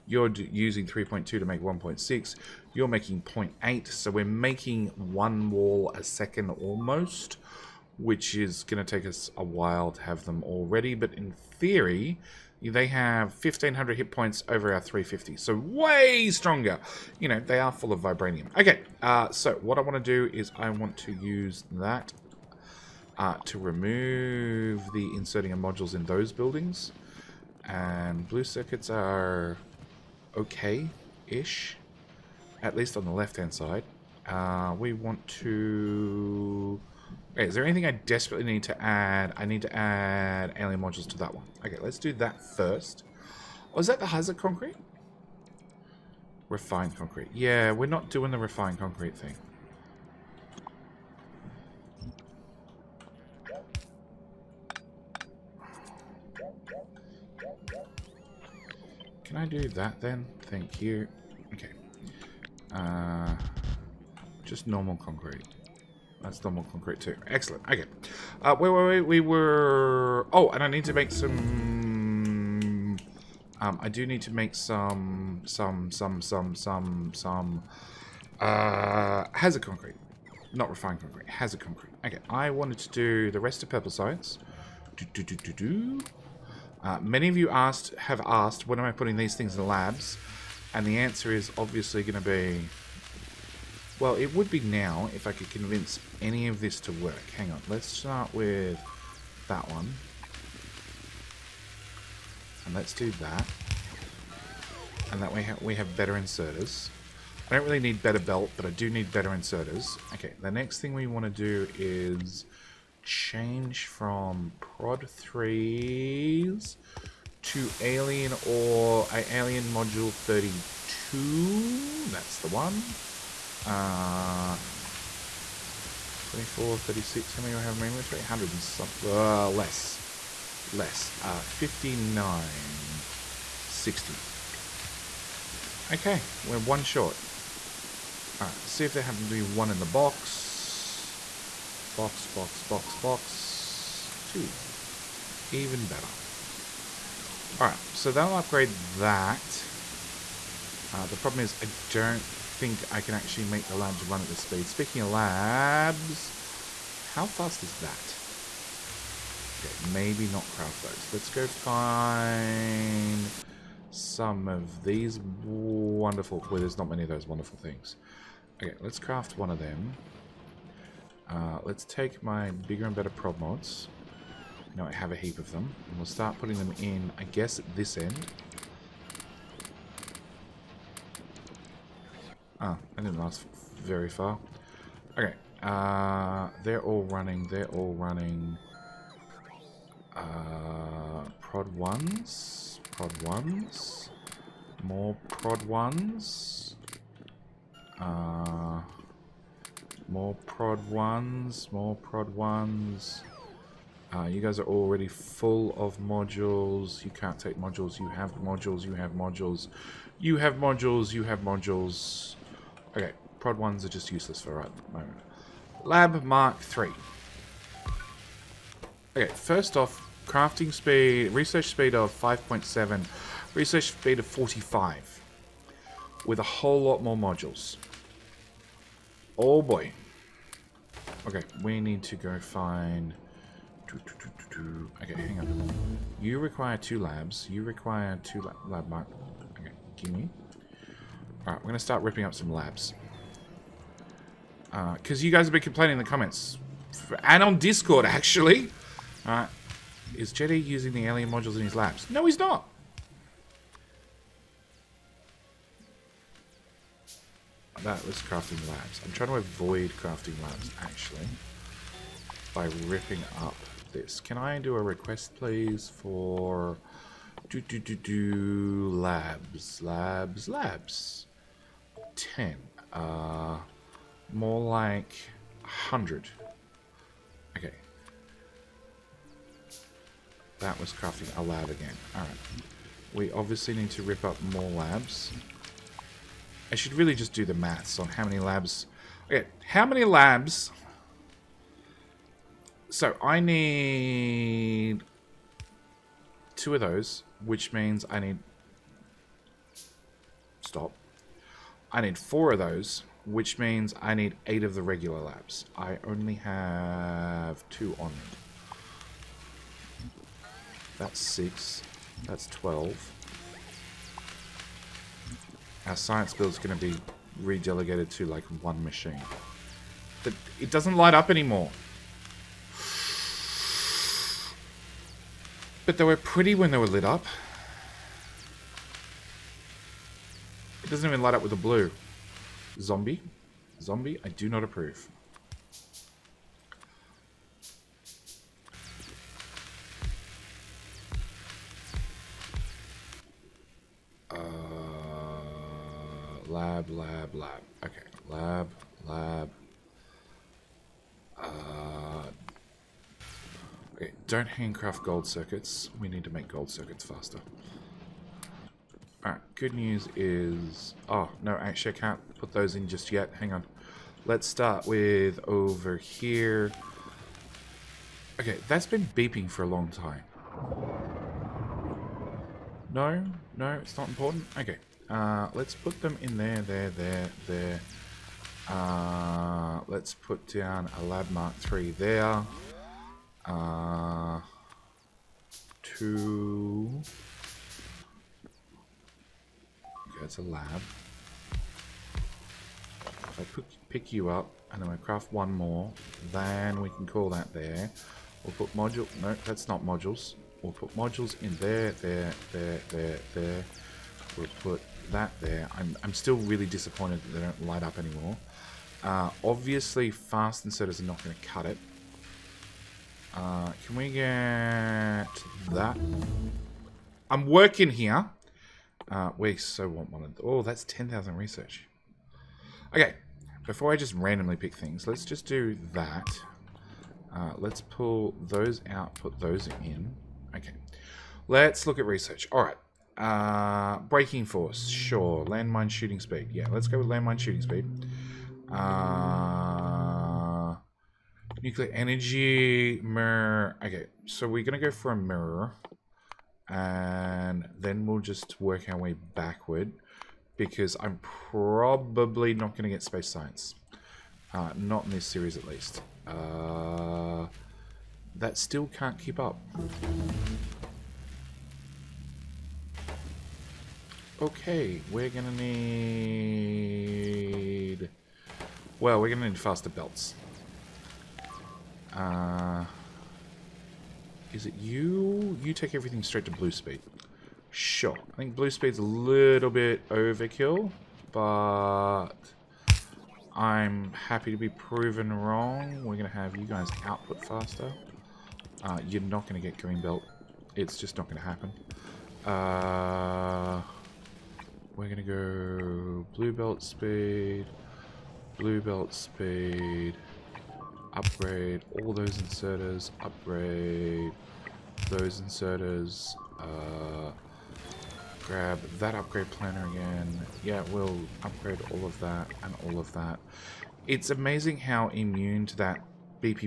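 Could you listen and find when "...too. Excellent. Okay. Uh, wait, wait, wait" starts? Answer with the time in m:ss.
1:06.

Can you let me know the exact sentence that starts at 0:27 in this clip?
And blue circuits are okay-ish, at least on the left-hand side.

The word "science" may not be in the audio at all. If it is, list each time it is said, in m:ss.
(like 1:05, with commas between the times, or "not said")
1:23, 5:15, 7:33.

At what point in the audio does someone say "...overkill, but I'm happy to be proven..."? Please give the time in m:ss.
8:00.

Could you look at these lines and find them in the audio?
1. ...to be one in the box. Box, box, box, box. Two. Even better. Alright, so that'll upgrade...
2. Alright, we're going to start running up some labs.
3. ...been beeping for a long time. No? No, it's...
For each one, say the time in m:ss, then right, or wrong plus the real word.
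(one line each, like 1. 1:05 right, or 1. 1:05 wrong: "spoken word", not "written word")
1. 2:19 right
2. 4:01 wrong: "ripping", not "running"
3. 6:08 right.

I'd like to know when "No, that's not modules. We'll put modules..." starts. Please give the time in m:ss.
6:39.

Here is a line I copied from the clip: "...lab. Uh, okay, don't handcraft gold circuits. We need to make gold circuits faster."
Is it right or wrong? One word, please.
right.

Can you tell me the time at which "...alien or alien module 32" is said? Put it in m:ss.
1:57.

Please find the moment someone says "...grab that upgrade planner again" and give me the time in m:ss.
8:28.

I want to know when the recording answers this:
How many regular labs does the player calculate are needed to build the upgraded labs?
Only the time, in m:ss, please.
5:04.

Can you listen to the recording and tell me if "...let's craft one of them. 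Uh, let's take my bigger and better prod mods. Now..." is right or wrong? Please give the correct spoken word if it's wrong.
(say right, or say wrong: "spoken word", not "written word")
right.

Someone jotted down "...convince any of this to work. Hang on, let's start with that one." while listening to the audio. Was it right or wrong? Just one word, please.
right.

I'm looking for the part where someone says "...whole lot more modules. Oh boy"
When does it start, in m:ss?
3:46.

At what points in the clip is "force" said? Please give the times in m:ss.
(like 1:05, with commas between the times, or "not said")
7:14.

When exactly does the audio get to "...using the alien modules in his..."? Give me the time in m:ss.
4:10.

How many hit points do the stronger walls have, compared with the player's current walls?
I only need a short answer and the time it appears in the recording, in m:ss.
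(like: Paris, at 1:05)
1500, at 0:13.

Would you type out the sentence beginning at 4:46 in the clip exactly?
I should really just do the maths on how many labs...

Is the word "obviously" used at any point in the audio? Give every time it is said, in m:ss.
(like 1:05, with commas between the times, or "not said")
1:31, 4:43, 6:49.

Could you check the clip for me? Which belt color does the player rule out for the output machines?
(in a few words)
Green belt.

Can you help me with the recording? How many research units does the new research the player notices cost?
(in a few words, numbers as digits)
10,000.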